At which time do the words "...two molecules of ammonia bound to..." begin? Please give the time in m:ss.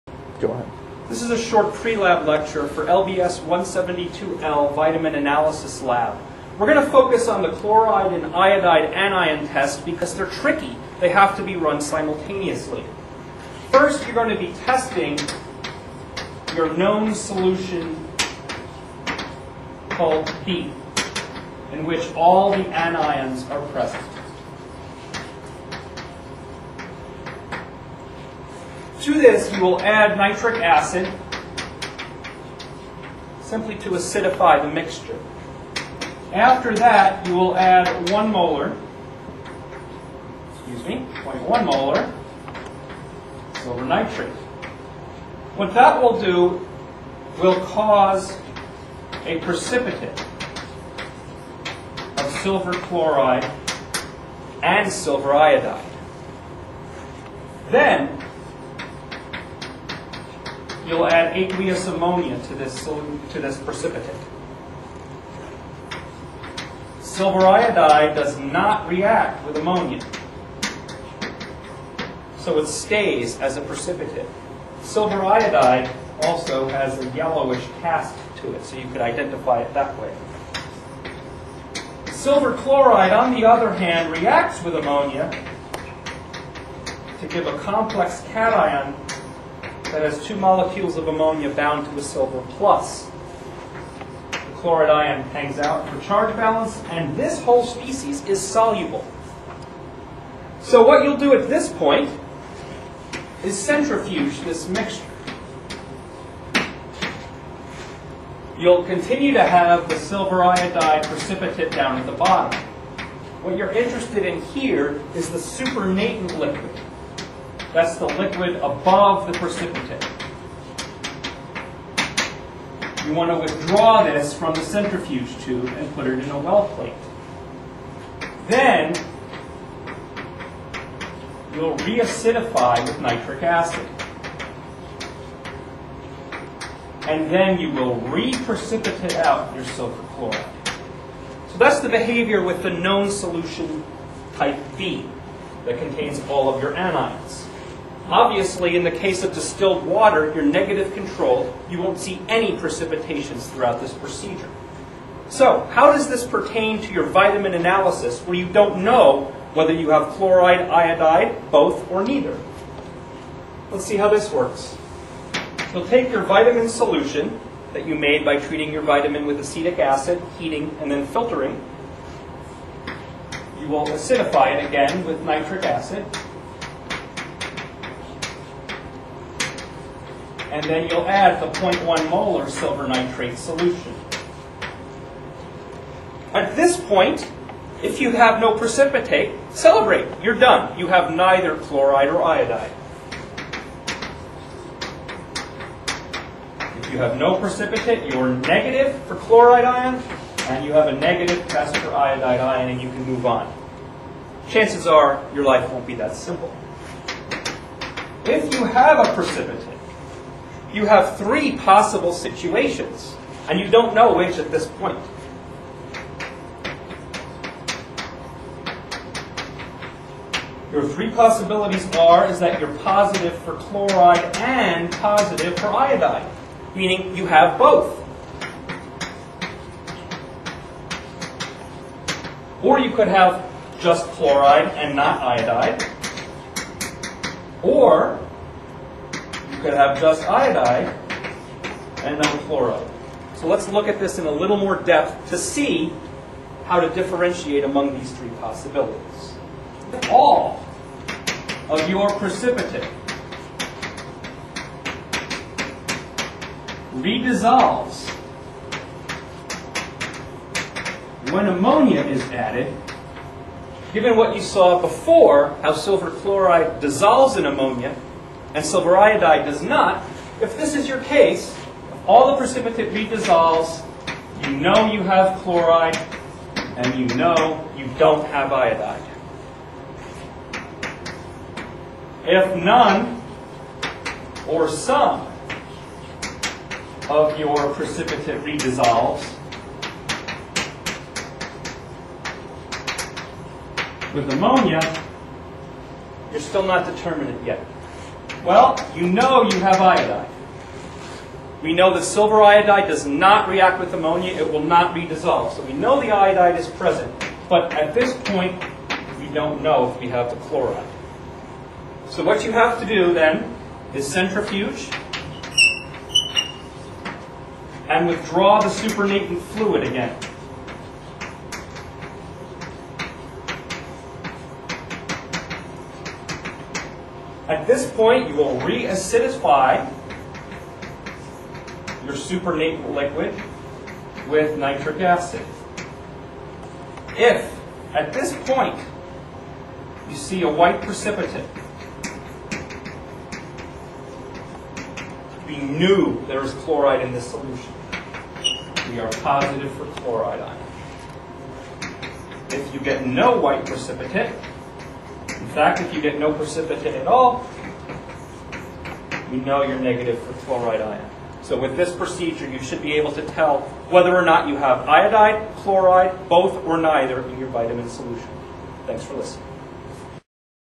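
1:30.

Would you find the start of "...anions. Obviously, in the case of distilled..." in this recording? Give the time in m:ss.
2:26.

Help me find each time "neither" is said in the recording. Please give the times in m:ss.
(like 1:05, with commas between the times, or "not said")
2:42, 3:11, 6:06.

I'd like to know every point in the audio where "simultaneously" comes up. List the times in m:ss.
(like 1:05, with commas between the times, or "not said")
0:11.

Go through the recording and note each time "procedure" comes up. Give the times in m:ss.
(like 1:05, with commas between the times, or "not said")
2:33, 6:01.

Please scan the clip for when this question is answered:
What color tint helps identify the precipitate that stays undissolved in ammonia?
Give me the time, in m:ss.
1:17.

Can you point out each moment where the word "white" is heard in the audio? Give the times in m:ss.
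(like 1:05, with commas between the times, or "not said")
5:40, 5:53.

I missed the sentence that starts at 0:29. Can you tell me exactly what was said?
To this, you will add nitric acid simply to acidify the mixture.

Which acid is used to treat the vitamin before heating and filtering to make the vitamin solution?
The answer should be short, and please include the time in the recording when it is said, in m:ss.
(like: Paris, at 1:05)
acetic acid, at 2:49.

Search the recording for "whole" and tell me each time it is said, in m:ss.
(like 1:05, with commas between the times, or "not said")
1:37.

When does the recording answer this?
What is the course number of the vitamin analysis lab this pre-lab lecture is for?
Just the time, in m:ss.
0:02.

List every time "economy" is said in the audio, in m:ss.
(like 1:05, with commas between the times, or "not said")
not said.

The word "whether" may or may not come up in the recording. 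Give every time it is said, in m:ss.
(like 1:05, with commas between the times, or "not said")
2:39, 6:03.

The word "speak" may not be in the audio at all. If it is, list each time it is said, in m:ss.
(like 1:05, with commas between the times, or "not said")
not said.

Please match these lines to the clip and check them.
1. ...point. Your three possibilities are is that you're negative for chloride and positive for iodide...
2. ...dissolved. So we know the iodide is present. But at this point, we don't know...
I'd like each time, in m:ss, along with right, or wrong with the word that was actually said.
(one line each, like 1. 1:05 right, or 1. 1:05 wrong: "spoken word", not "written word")
1. 3:34 wrong: "positive", not "negative"
2. 5:05 right.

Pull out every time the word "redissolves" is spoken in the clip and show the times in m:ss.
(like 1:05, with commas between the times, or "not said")
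4:16, 4:32, 4:48.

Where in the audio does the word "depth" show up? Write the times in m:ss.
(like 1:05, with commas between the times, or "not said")
4:04.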